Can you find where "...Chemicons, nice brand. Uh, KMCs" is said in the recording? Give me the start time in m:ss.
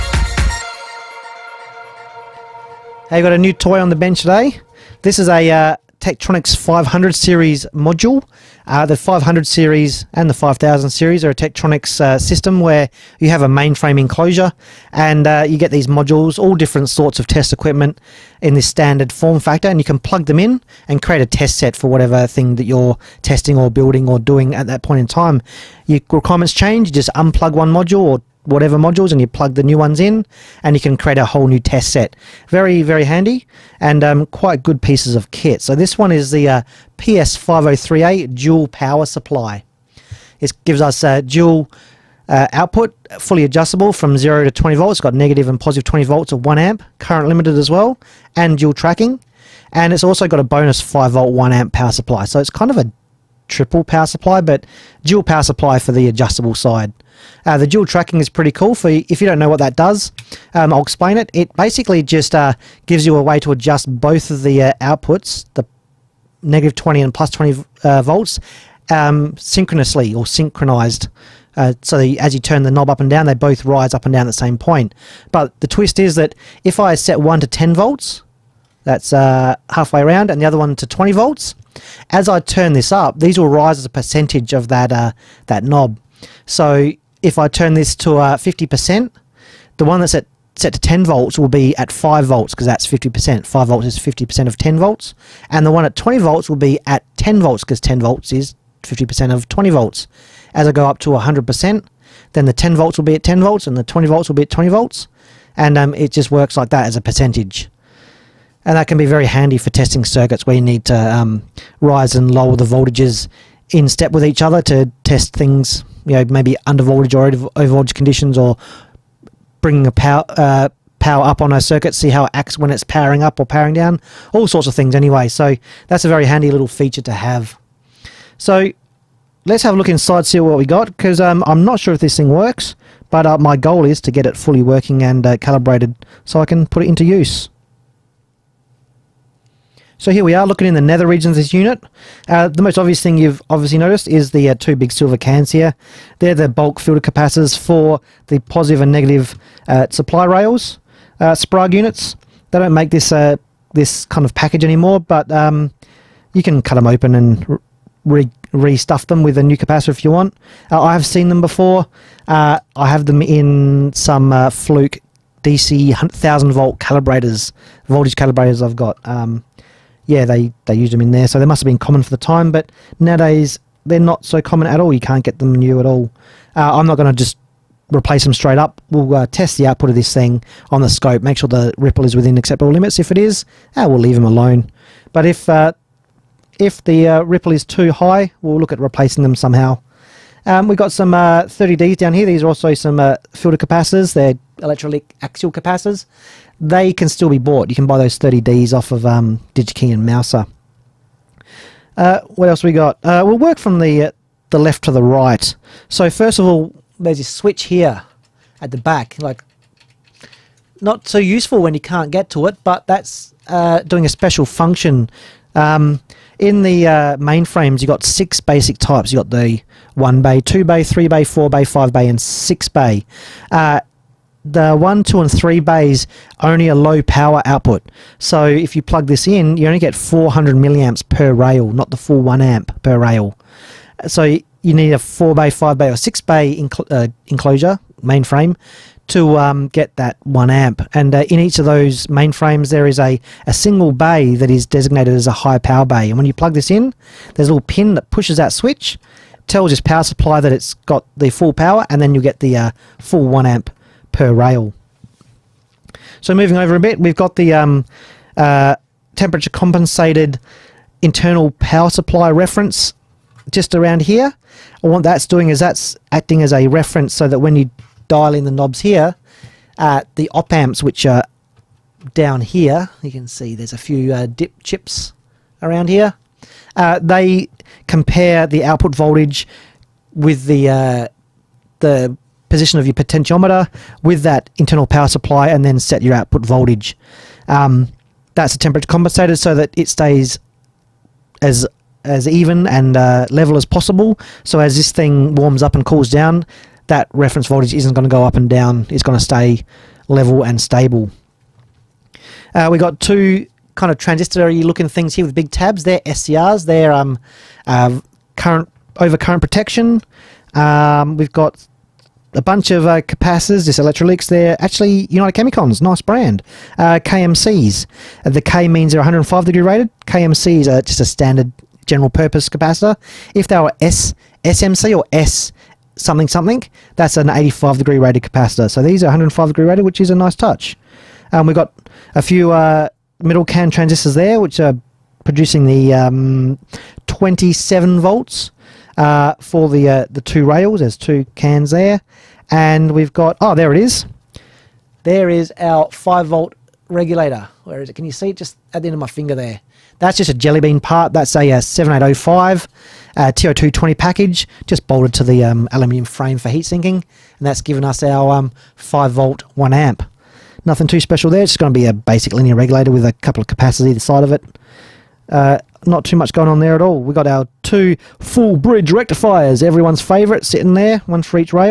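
5:15.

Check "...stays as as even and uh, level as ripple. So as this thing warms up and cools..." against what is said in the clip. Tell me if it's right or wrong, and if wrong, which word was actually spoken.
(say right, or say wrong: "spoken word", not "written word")
wrong: "possible", not "ripple".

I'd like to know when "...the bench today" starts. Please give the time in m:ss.
0:03.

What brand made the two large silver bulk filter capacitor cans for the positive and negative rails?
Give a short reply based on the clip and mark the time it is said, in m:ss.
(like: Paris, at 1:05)
Sprague, at 2:31.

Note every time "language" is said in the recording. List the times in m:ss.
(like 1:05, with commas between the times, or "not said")
not said.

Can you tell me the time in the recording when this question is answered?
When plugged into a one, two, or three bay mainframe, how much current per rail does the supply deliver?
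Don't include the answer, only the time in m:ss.
3:49.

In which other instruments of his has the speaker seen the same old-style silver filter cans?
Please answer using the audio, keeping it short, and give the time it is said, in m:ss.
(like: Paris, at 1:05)
Fluke DC 1000 volt calibrators, at 2:44.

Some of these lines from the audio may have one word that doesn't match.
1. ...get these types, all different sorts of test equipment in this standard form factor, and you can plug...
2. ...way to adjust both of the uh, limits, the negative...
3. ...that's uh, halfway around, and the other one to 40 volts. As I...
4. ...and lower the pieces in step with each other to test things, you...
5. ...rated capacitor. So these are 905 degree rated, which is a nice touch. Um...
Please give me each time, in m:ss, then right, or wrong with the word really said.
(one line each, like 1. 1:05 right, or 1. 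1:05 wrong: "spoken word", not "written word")
1. 0:15 wrong: "modules", not "types"
2. 1:03 wrong: "outputs", not "limits"
3. 1:18 wrong: "20", not "40"
4. 1:52 wrong: "voltages", not "pieces"
5. 5:27 wrong: "105", not "905".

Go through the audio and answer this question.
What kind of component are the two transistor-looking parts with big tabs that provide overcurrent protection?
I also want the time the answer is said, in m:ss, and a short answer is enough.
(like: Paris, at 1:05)
SCRs, at 5:06.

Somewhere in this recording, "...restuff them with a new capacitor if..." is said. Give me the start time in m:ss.
2:38.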